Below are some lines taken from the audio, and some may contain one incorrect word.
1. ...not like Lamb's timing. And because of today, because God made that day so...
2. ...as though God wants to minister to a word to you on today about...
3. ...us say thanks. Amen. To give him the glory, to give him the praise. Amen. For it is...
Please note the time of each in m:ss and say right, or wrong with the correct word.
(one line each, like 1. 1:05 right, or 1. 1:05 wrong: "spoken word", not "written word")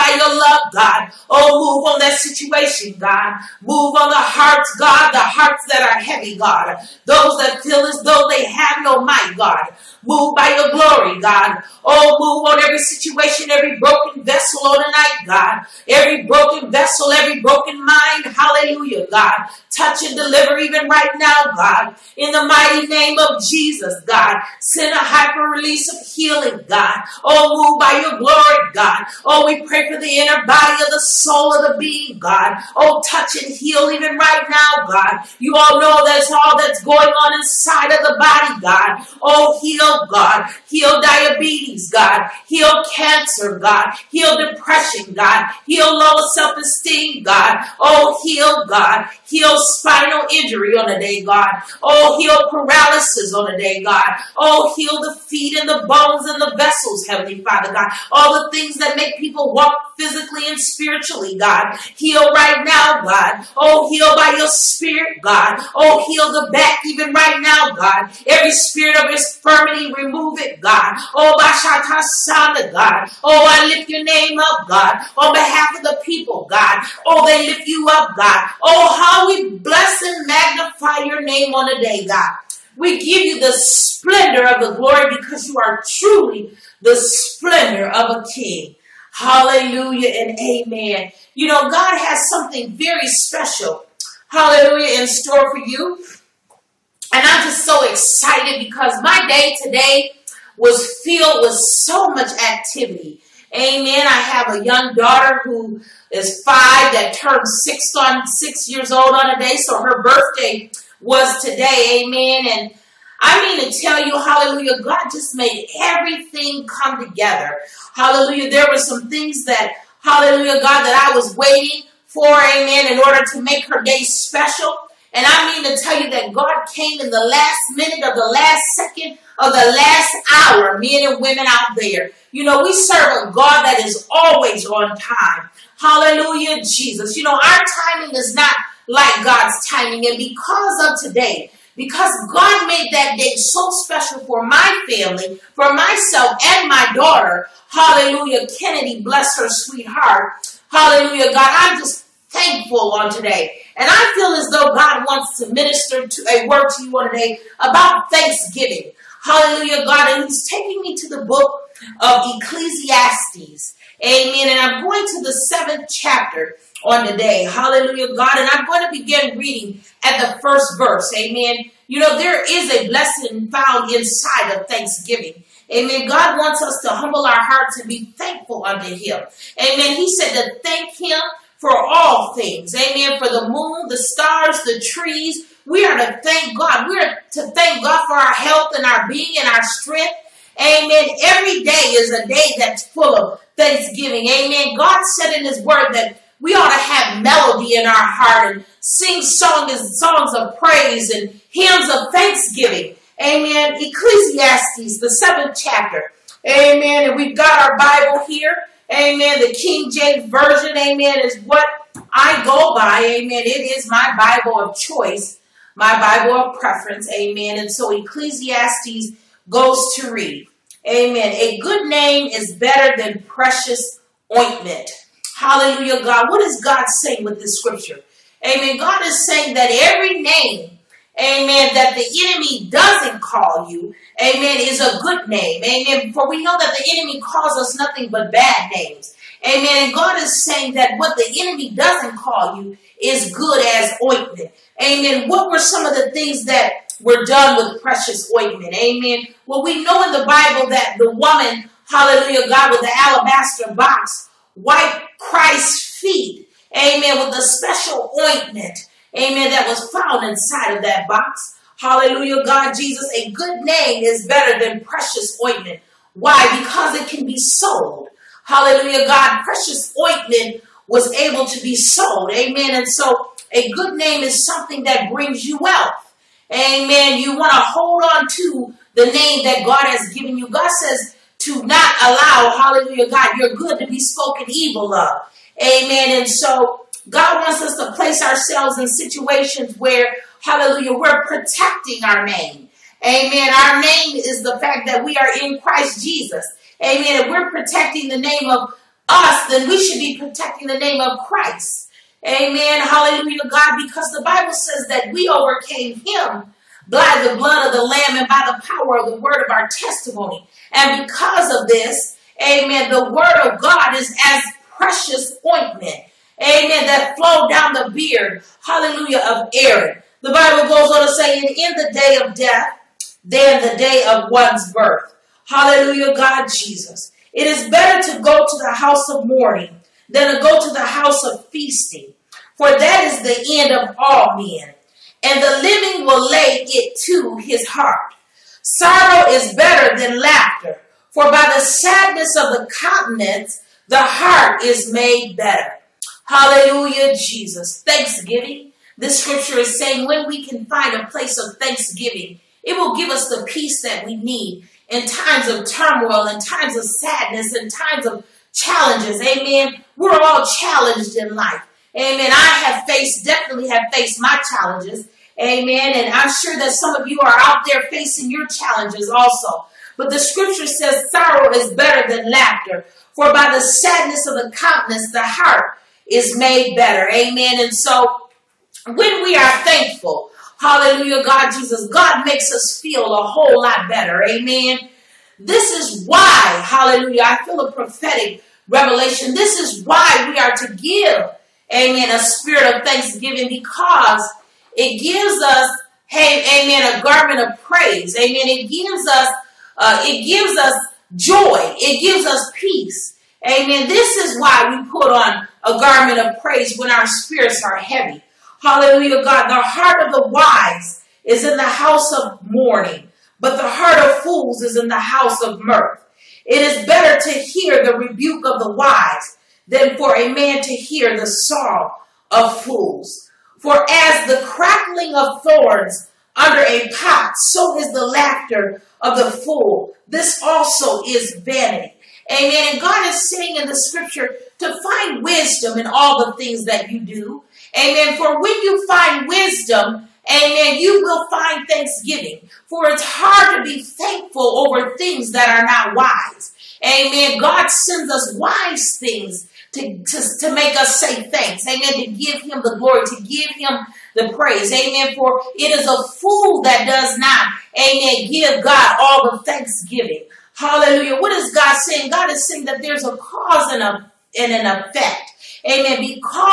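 1. 2:18 wrong: "God", not "Lamb"
2. 2:34 right
3. 7:30 right.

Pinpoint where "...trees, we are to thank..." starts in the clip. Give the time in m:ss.
3:04.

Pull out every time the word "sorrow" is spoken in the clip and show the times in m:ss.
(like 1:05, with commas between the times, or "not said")
5:38, 6:11.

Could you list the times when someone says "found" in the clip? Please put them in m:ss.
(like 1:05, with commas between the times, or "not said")
2:53, 4:19.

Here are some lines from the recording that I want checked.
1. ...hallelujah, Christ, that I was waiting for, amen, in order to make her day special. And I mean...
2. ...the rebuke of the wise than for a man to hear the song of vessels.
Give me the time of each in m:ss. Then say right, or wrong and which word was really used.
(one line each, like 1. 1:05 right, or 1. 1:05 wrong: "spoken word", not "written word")
1. 2:00 wrong: "God", not "Christ"
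2. 6:57 wrong: "fools", not "vessels".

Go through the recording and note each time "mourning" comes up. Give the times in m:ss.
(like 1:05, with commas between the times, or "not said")
5:29, 6:52.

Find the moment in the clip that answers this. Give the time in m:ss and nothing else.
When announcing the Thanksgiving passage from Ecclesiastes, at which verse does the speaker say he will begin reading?
2:50.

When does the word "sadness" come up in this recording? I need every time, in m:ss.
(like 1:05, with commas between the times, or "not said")
5:41, 5:56, 6:13.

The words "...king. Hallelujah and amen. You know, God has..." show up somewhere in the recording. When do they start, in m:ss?
1:28.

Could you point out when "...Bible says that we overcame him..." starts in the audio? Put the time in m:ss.
5:04.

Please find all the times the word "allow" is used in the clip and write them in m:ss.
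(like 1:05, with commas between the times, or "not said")
4:42.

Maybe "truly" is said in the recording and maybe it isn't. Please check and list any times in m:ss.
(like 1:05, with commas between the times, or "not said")
1:25.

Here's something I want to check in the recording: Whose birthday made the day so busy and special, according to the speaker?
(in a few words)
Kennedy.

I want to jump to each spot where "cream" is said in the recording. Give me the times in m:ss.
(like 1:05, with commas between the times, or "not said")
not said.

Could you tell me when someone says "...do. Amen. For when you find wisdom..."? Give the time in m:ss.
7:17.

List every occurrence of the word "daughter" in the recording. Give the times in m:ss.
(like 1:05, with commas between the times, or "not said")
1:44, 2:26.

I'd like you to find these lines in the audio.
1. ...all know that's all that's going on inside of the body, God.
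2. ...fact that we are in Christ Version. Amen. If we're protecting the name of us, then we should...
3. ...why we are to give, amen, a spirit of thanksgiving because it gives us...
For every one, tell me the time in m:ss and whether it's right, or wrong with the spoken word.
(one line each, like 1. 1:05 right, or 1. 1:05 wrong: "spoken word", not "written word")
1. 0:35 right
2. 4:54 wrong: "Jesus", not "Version"
3. 6:29 right.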